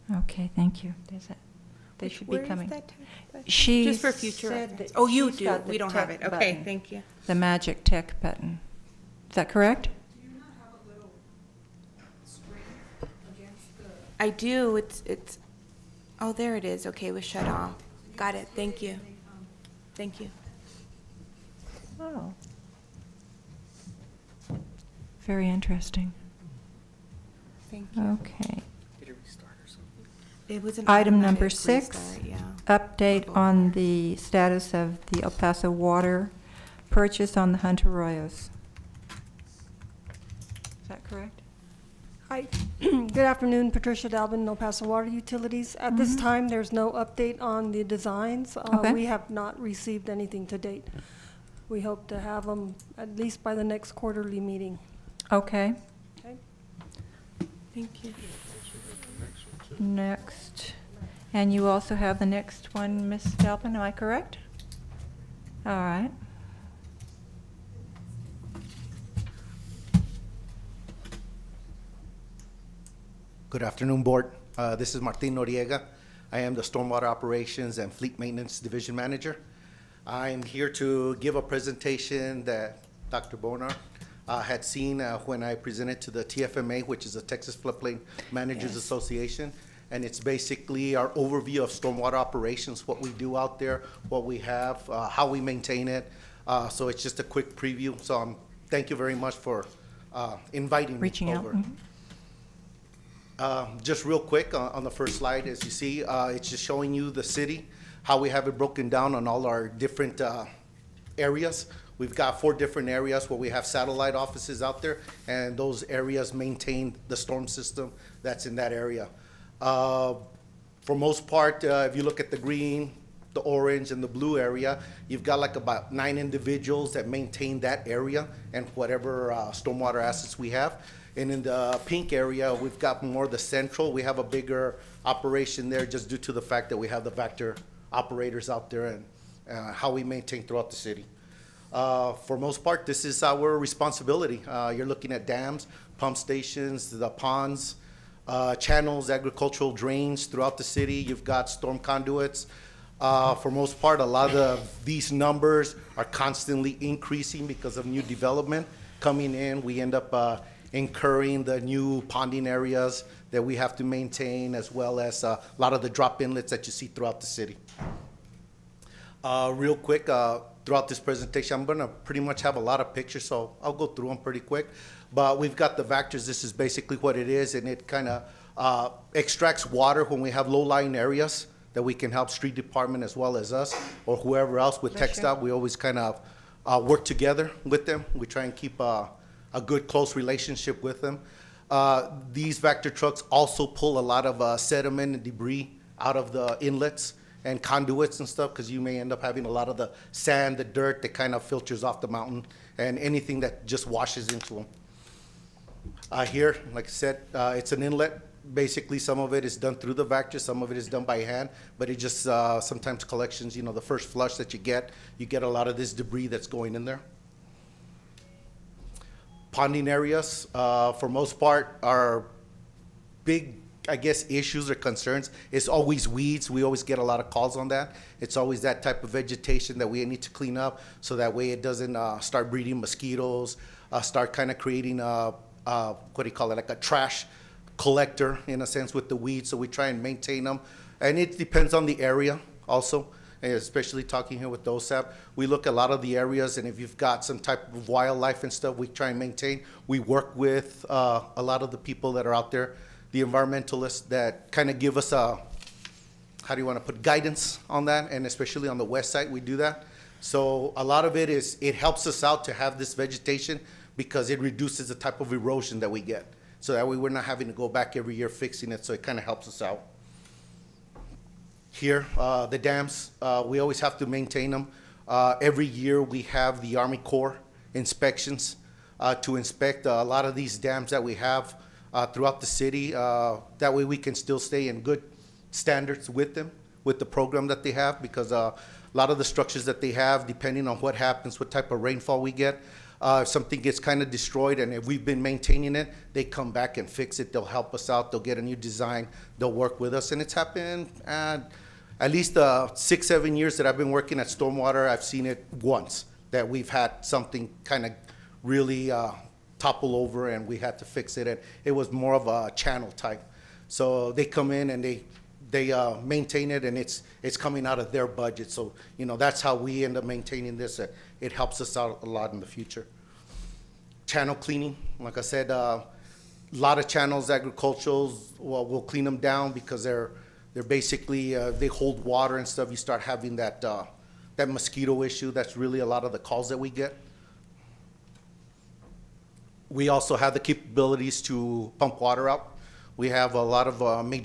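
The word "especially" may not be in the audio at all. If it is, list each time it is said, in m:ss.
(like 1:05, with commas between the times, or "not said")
4:03, 4:18.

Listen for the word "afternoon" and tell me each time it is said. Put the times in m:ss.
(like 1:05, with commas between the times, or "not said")
0:43, 1:13.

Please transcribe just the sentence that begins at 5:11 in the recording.
And it was more of a channel type.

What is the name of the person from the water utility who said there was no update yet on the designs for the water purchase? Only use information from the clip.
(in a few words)
Patricia Dalvin.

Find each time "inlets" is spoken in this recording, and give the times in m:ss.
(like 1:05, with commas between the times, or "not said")
2:46, 3:16, 3:27.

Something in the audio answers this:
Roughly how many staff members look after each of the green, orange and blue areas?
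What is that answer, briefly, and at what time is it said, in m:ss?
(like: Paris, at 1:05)
9, at 2:05.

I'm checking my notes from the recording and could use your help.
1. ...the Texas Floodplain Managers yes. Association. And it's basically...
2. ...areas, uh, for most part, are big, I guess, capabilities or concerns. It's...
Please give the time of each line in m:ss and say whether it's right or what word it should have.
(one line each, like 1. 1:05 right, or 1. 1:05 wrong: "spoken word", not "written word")
1. 1:27 right
2. 3:39 wrong: "issues", not "capabilities".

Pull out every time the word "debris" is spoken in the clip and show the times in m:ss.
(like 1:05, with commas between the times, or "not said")
3:15, 3:35.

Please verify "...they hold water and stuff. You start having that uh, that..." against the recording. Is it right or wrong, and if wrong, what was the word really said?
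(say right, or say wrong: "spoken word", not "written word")
right.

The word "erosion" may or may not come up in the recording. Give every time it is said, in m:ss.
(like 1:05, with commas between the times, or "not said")
4:25.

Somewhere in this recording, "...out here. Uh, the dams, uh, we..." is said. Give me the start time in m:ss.
4:29.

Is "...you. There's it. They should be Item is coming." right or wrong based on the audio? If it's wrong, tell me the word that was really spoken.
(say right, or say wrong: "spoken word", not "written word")
wrong: "Where", not "Item".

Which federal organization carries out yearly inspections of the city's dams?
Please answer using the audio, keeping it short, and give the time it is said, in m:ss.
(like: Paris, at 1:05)
Army Corps, at 4:36.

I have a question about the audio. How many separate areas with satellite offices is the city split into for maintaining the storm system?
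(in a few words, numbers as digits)
4.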